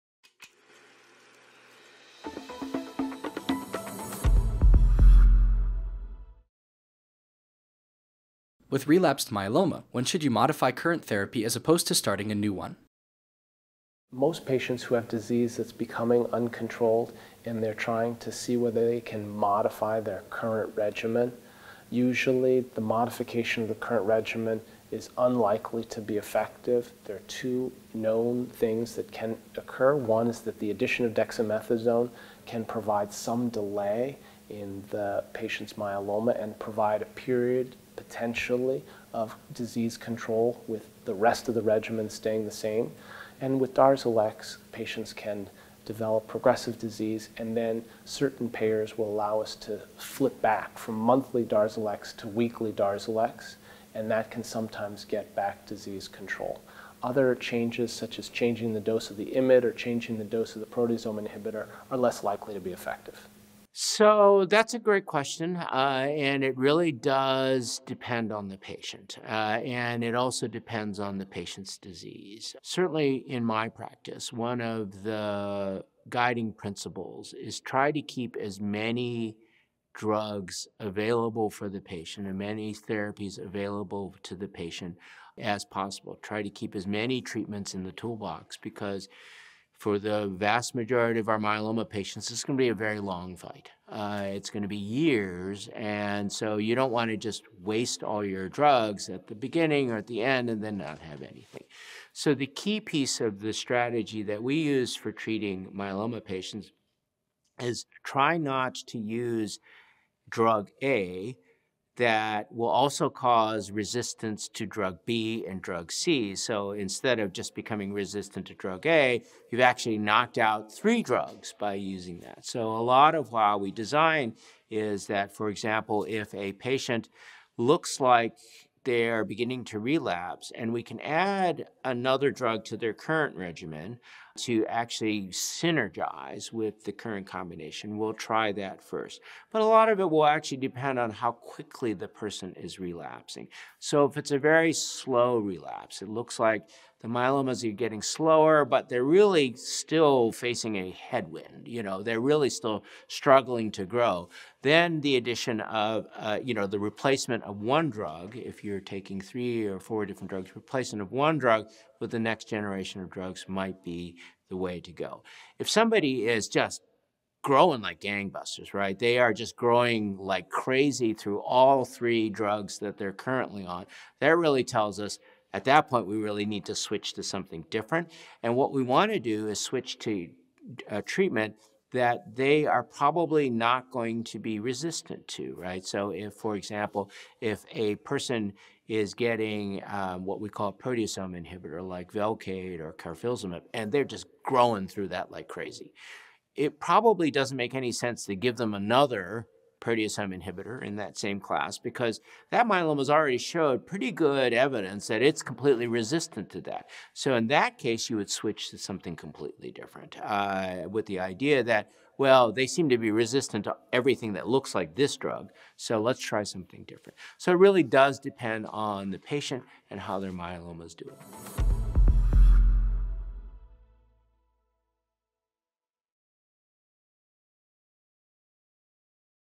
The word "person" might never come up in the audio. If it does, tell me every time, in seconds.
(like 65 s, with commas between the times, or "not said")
142 s, 187 s.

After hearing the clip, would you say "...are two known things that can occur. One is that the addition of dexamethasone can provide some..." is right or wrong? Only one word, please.
right.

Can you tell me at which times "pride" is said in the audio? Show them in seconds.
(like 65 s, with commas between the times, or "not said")
not said.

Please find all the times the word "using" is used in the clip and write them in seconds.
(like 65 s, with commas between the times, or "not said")
121 s.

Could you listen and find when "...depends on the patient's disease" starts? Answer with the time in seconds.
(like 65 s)
70 s.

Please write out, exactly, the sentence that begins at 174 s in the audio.
That really tells us at that point we really need to switch to something different.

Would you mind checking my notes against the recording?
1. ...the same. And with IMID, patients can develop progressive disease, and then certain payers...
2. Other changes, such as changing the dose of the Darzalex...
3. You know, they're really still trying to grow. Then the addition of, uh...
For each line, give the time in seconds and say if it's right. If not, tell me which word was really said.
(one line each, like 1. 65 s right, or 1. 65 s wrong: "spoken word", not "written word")
1. 42 s wrong: "Darzalex", not "IMID"
2. 57 s wrong: "IMID", not "Darzalex"
3. 151 s wrong: "struggling", not "trying".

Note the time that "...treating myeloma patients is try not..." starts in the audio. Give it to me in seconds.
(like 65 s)
105 s.